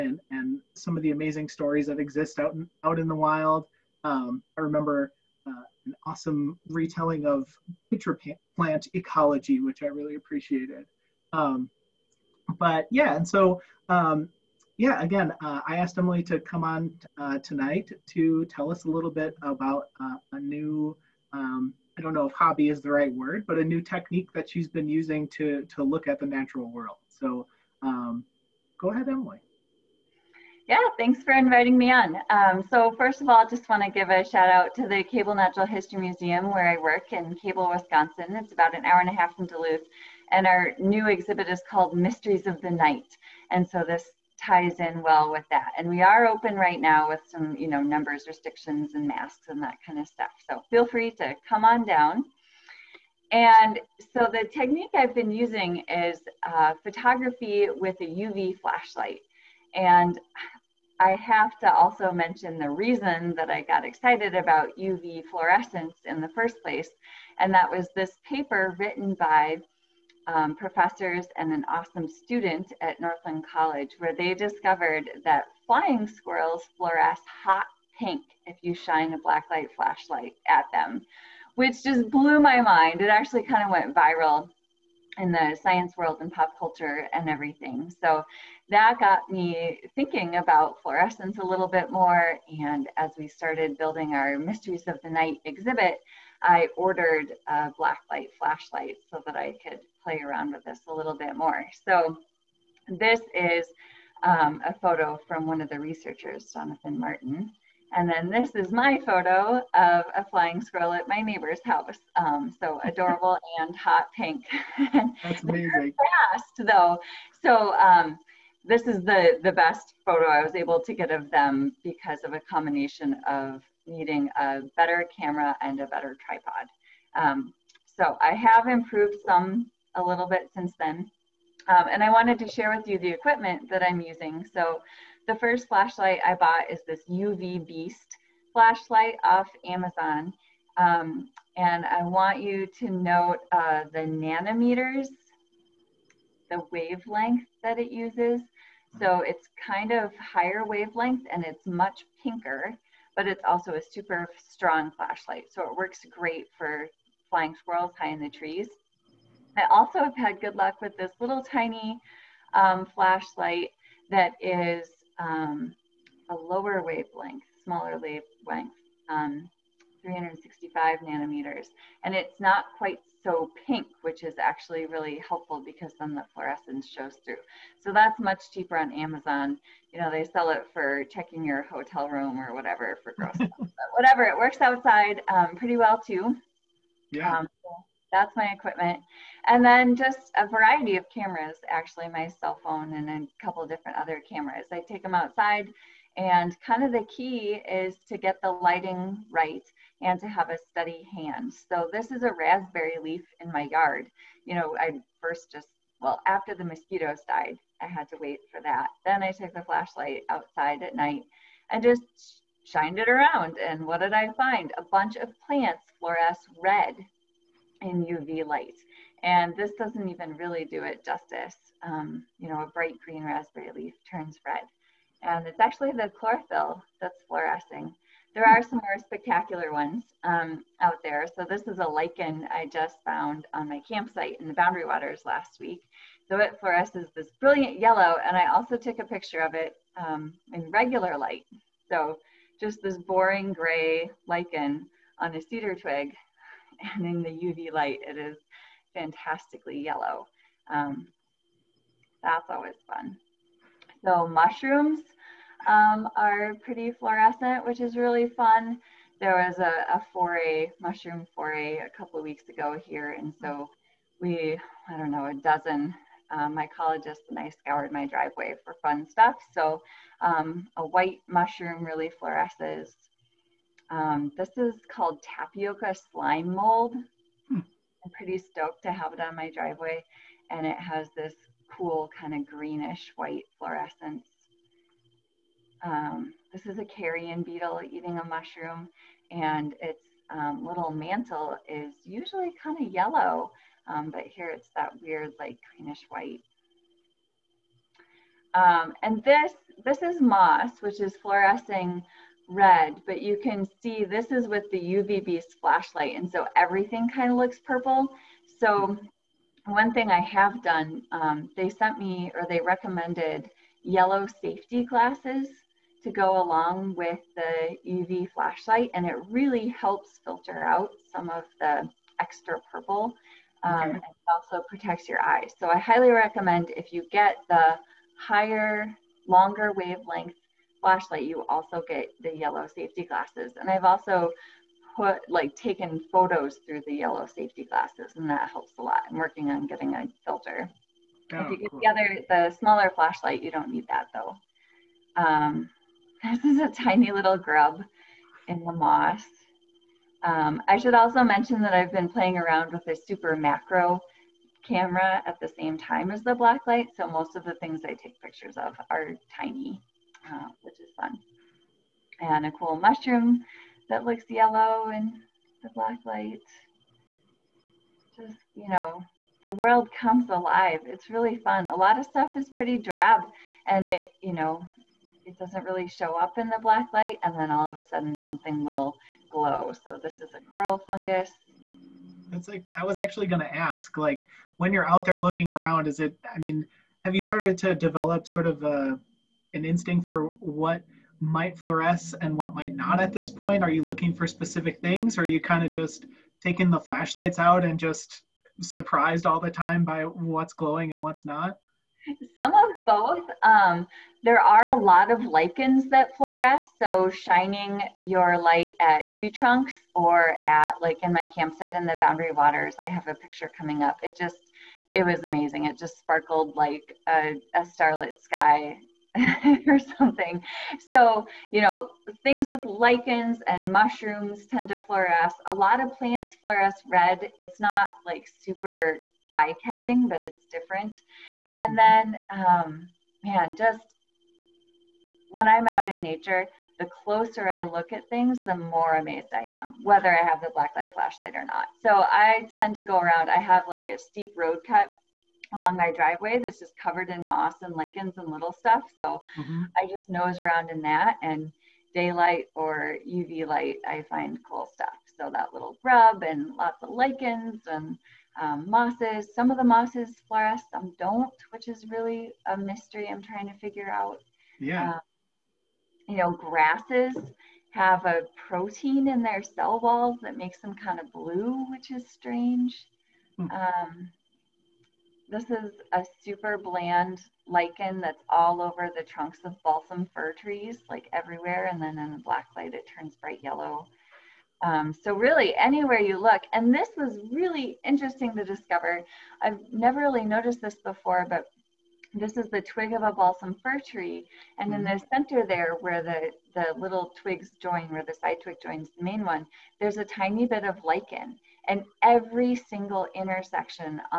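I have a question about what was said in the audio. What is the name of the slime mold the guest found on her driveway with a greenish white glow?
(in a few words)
Tapioca slime mold.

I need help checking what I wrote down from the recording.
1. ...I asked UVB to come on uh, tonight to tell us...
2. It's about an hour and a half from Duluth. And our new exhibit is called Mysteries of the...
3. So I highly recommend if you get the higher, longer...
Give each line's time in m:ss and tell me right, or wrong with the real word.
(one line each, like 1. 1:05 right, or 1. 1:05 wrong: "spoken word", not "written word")
1. 0:15 wrong: "Emily", not "UVB"
2. 0:38 right
3. 5:25 right.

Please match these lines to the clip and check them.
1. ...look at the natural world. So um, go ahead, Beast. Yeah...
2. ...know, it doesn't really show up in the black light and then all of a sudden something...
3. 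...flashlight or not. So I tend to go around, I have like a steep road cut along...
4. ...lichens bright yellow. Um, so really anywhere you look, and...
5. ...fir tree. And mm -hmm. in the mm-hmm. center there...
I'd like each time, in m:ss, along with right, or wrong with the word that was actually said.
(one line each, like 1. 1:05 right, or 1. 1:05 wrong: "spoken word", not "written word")
1. 0:25 wrong: "Emily", not "Beast"
2. 6:14 right
3. 7:20 right
4. 8:02 wrong: "turns", not "lichens"
5. 8:13 right.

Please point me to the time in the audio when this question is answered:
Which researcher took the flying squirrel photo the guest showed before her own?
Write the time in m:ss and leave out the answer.
1:46.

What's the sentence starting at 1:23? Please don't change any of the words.
It actually kind of went viral in the science world and pop culture and everything.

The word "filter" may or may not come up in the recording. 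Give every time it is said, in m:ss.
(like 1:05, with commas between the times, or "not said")
5:20, 5:40.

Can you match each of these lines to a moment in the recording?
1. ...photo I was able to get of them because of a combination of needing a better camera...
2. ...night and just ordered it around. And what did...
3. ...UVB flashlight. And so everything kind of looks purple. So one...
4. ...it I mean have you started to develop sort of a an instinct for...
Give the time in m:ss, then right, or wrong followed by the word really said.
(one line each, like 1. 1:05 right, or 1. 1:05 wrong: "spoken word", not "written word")
1. 2:00 right
2. 3:30 wrong: "shined", not "ordered"
3. 5:04 right
4. 6:25 right.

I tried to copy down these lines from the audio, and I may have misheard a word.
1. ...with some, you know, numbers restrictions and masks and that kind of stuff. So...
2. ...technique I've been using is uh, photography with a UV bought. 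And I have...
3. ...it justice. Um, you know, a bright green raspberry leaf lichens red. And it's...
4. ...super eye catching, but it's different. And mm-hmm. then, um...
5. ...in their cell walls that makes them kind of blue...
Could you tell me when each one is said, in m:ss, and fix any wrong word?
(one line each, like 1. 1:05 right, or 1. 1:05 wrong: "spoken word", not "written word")
1. 0:47 right
2. 0:54 wrong: "flashlight", not "bought"
3. 3:40 wrong: "turns", not "lichens"
4. 7:08 right
5. 7:49 right.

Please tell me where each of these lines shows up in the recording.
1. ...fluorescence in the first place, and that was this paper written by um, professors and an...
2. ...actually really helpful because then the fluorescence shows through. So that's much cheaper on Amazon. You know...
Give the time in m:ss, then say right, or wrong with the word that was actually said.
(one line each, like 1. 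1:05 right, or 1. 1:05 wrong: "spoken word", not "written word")
1. 1:05 right
2. 2:54 right.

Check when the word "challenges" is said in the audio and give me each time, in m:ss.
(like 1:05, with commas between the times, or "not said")
not said.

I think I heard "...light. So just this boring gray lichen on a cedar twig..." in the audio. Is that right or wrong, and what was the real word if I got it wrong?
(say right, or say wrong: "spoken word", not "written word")
right.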